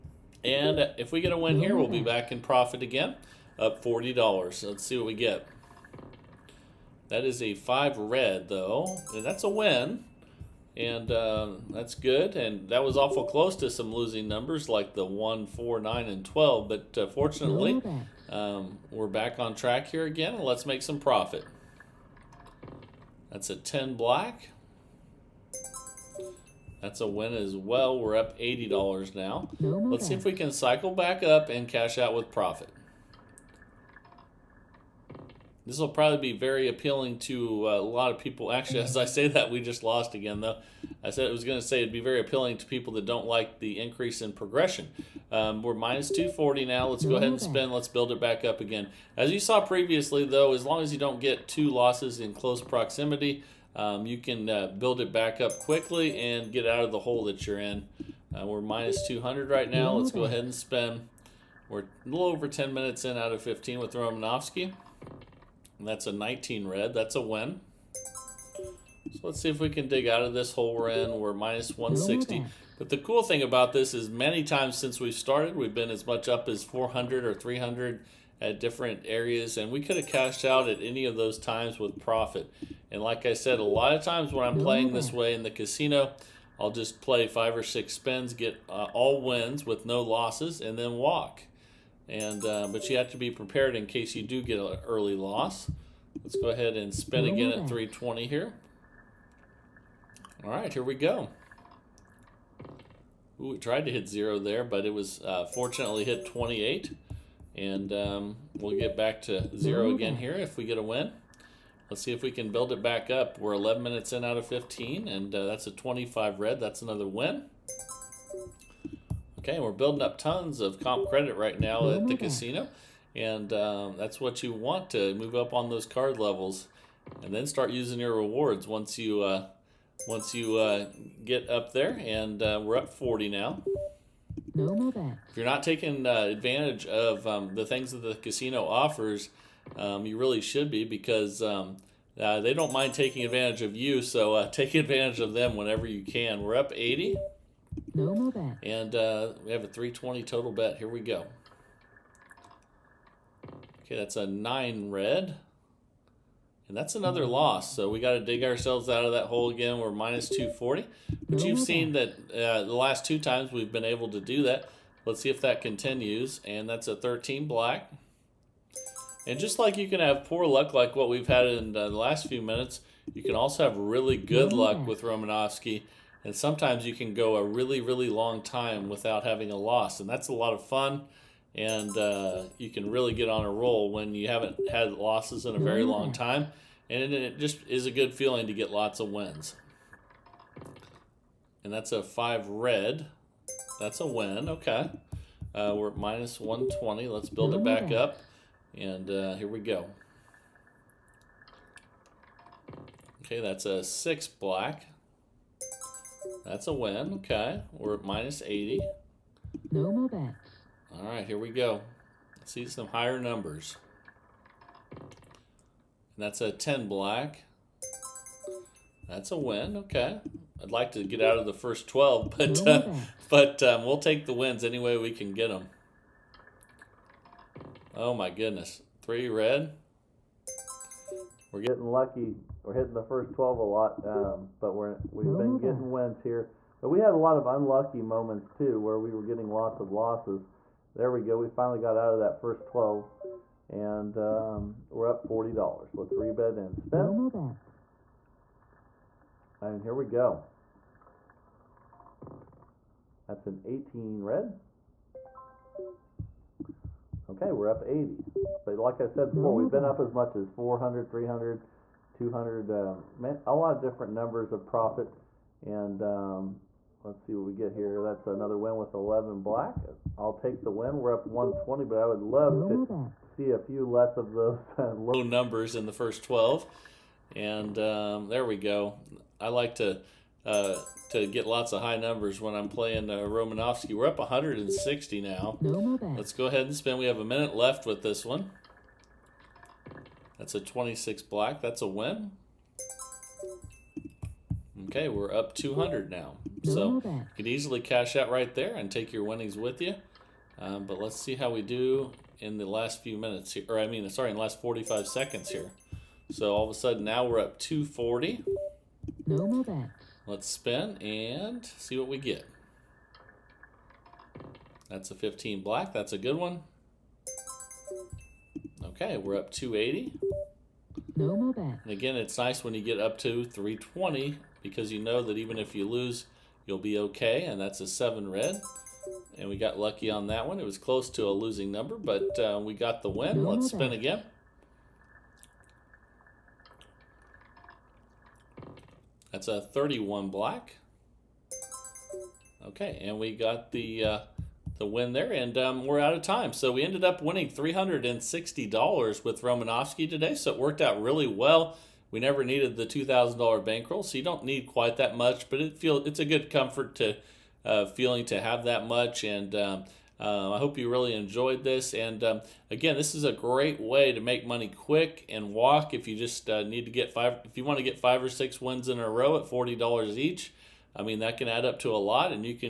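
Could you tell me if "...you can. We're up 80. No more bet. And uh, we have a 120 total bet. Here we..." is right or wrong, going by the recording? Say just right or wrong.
wrong.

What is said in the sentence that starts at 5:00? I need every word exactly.
Um, but let's see how we do in the last few minutes here.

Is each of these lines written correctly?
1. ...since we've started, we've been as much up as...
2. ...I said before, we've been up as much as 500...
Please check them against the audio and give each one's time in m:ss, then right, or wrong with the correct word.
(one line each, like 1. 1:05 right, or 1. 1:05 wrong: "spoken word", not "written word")
1. 1:14 right
2. 4:18 wrong: "400", not "500".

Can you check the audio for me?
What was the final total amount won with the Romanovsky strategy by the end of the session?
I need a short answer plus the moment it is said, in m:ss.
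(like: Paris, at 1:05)
$360, at 5:47.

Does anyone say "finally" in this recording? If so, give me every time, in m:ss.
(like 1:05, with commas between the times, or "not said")
4:01.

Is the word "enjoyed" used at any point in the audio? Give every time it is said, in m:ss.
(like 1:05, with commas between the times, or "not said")
6:01.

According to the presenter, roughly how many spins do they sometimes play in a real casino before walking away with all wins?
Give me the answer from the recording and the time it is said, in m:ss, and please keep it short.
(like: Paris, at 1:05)
5 or 6, at 1:27.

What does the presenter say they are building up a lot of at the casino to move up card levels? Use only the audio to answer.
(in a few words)
Comp credit.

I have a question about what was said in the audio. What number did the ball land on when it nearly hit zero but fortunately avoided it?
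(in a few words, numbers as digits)
28.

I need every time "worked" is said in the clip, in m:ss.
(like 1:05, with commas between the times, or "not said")
5:50.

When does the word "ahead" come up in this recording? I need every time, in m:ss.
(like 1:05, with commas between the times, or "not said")
0:47, 1:00, 1:36, 4:46.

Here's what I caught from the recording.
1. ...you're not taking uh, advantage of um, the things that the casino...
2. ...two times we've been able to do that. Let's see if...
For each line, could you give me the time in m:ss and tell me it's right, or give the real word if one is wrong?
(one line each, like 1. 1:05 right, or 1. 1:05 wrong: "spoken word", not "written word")
1. 2:15 right
2. 2:43 right.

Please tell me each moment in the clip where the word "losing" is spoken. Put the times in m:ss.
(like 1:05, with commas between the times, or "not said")
0:13, 5:31.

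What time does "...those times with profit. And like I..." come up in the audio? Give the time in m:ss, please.
1:21.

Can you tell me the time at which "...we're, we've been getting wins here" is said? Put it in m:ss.
3:54.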